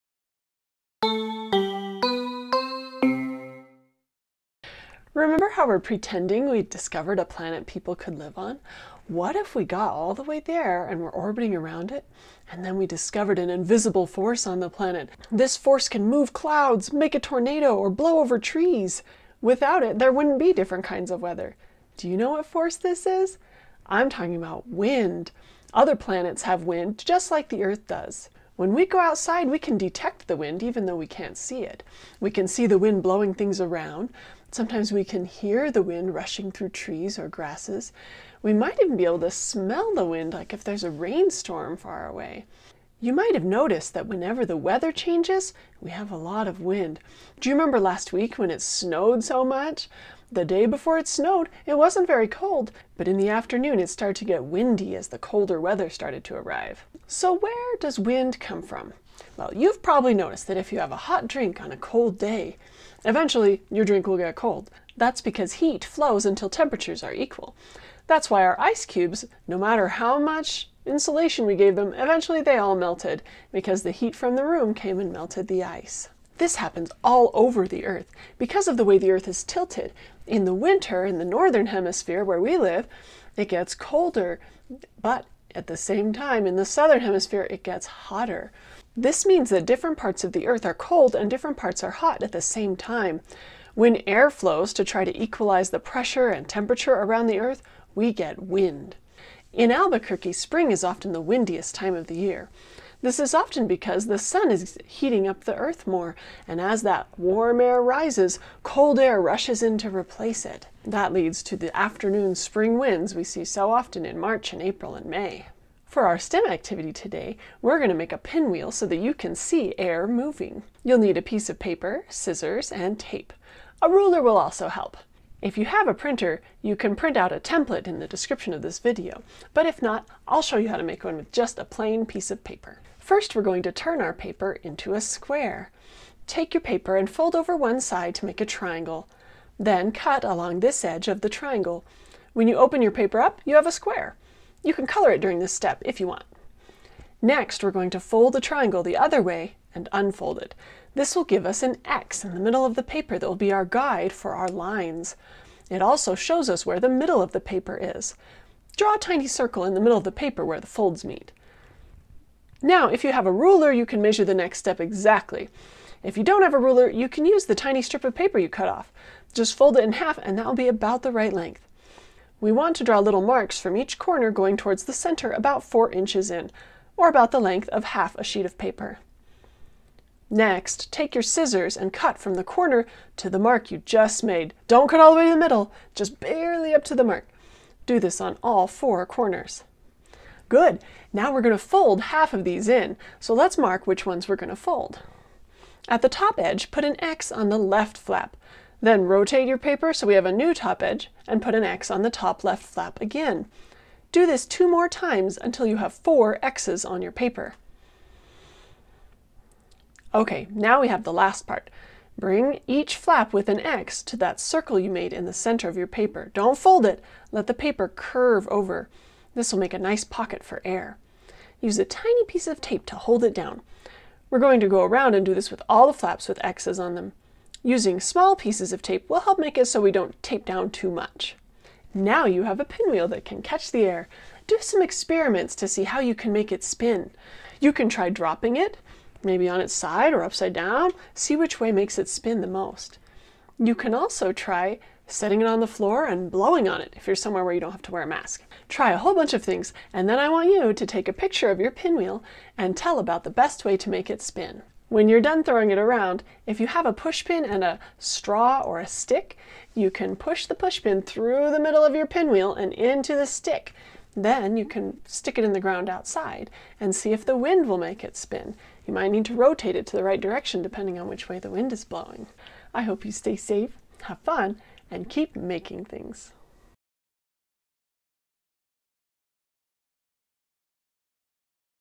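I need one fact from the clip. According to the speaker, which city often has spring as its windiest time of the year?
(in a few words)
Albuquerque.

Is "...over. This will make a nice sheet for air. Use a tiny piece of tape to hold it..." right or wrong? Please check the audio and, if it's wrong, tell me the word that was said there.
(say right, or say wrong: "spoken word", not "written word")
wrong: "pocket", not "sheet".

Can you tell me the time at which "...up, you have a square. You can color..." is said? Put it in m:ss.
2:23.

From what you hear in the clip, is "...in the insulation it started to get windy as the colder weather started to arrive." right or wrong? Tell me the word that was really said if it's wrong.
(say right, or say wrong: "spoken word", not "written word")
wrong: "afternoon", not "insulation".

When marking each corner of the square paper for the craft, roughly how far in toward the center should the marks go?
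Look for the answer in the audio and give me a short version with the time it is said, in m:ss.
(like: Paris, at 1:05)
4 inches, at 2:55.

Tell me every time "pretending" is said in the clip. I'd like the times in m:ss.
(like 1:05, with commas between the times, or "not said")
0:05.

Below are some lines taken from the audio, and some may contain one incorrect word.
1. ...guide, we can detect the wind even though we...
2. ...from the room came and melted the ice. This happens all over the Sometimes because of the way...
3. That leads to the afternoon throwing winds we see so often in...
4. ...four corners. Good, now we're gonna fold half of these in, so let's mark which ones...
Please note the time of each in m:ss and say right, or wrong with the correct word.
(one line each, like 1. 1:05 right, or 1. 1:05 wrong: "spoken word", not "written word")
1. 0:28 wrong: "outside", not "guide"
2. 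1:14 wrong: "Earth", not "Sometimes"
3. 1:50 wrong: "spring", not "throwing"
4. 3:08 right.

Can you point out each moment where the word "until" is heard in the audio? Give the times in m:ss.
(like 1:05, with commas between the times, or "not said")
1:06, 3:25.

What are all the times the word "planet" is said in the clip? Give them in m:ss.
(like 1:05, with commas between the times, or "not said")
0:07, 0:14, 0:25.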